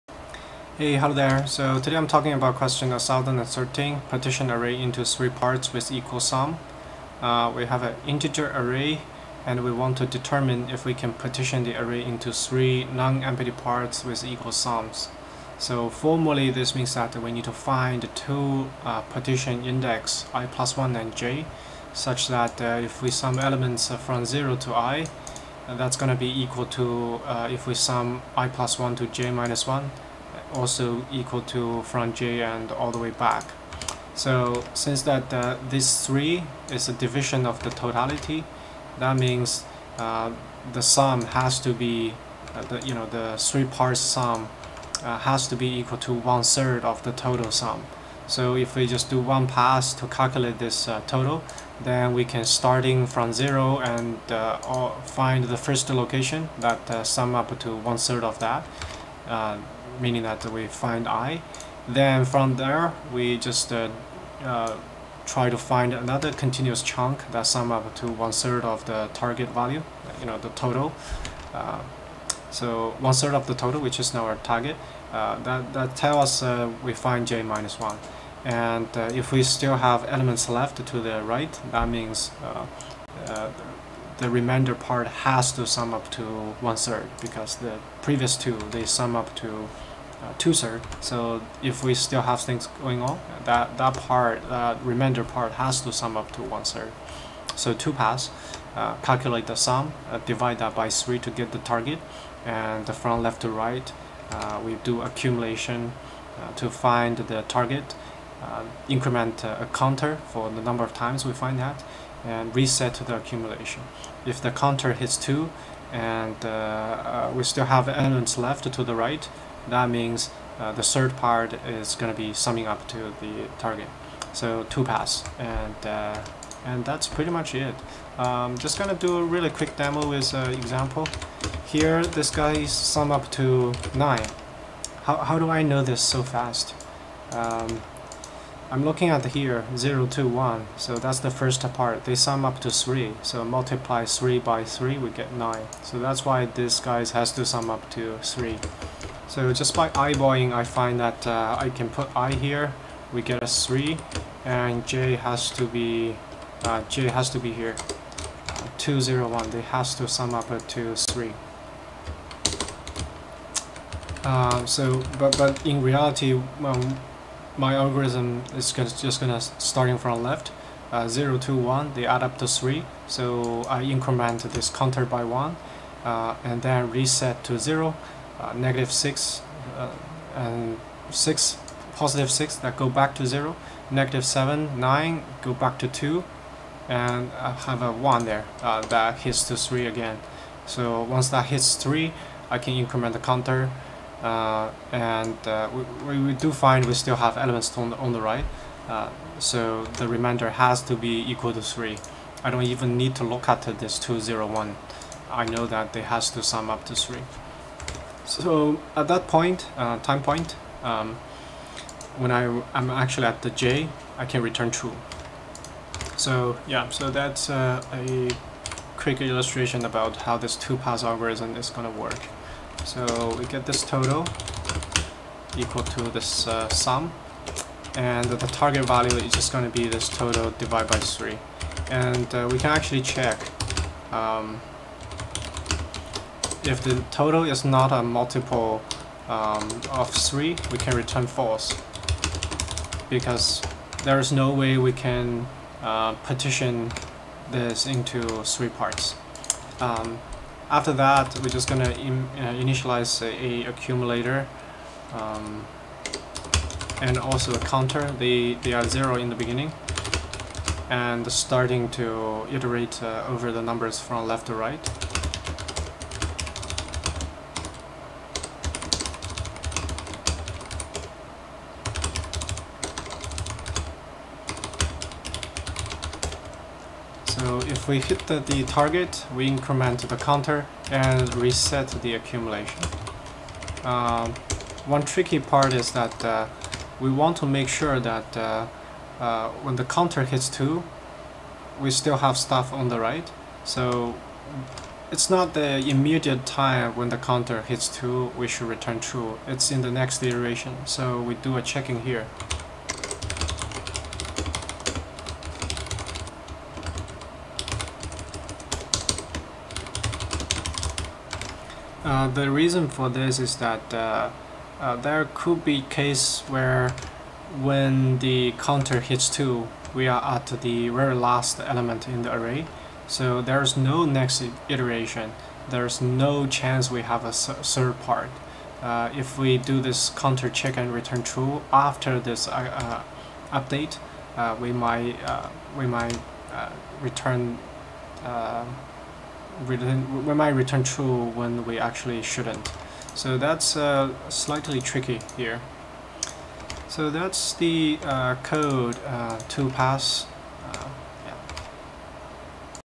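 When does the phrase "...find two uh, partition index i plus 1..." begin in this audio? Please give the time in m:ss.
0:17.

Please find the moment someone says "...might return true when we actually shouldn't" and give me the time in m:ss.
5:40.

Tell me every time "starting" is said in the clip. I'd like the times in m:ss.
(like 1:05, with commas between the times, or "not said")
0:52, 2:49, 4:21.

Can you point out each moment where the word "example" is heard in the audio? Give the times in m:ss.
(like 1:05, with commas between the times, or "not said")
2:10.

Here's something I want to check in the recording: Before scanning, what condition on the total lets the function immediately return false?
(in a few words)
Not a multiple of 3.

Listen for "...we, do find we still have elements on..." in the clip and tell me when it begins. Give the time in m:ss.
3:16.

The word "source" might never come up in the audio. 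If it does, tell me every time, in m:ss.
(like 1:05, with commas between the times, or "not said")
not said.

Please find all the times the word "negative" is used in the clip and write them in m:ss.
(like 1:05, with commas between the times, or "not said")
2:58, 3:03.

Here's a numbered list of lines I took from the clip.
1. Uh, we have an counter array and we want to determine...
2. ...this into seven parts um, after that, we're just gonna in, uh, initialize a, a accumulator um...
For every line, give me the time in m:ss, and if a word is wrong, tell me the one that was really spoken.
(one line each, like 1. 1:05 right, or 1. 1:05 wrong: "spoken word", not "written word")
1. 0:07 wrong: "integer", not "counter"
2. 4:07 wrong: "three", not "seven".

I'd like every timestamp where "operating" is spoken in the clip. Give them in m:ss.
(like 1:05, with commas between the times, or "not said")
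not said.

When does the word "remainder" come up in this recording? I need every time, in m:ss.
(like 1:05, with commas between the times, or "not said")
1:24, 1:34, 3:20.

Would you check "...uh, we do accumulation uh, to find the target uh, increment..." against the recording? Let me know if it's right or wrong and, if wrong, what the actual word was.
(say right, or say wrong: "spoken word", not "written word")
right.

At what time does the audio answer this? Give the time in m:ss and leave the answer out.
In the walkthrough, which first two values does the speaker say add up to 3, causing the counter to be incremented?
2:51.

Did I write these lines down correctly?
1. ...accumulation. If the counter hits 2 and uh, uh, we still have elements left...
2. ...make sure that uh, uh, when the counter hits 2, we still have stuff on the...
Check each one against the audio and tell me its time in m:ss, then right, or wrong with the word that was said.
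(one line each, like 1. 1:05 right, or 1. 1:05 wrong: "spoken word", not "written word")
1. 1:53 right
2. 4:47 right.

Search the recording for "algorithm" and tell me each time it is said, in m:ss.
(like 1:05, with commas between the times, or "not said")
2:47, 3:41.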